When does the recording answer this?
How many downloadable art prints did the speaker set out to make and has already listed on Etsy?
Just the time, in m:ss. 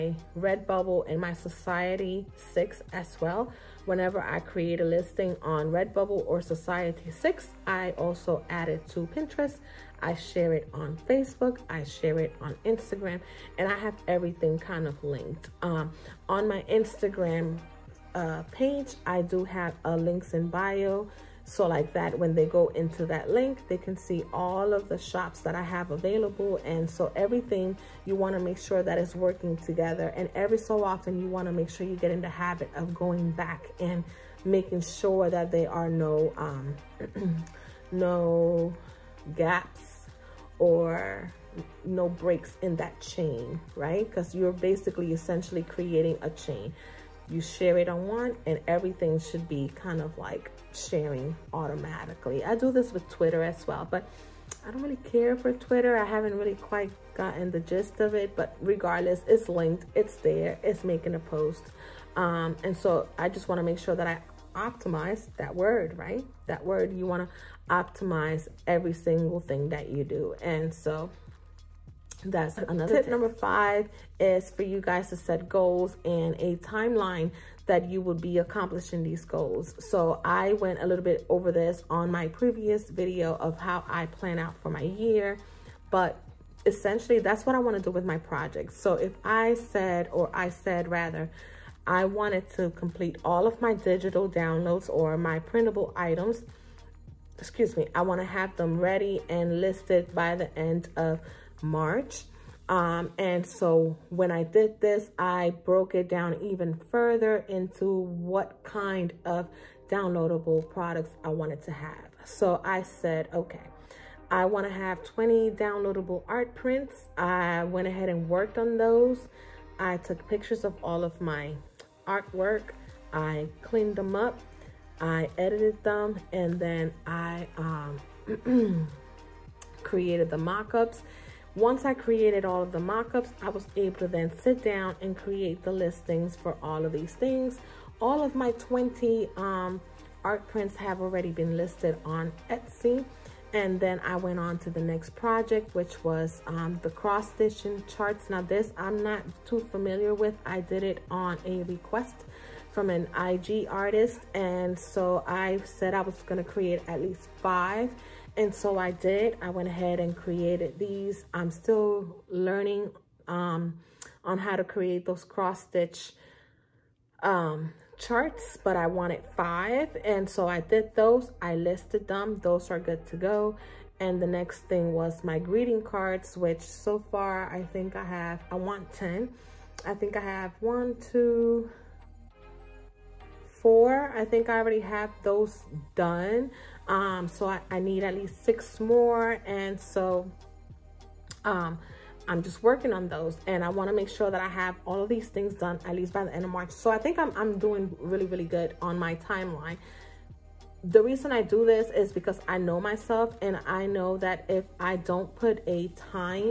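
1:55.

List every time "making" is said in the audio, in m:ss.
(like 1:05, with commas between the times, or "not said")
0:34, 1:00.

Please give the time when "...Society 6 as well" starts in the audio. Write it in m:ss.
0:01.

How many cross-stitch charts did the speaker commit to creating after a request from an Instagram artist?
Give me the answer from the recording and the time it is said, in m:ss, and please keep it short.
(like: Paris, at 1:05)
5, at 2:36.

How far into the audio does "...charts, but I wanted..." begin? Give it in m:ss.
2:47.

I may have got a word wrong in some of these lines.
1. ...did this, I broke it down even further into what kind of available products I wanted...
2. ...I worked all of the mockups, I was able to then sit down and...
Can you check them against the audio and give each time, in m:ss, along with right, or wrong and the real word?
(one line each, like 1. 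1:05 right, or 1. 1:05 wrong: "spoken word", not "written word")
1. 1:44 wrong: "downloadable", not "available"
2. 2:11 wrong: "created", not "worked".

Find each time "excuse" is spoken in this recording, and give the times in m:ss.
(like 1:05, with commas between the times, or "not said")
1:37.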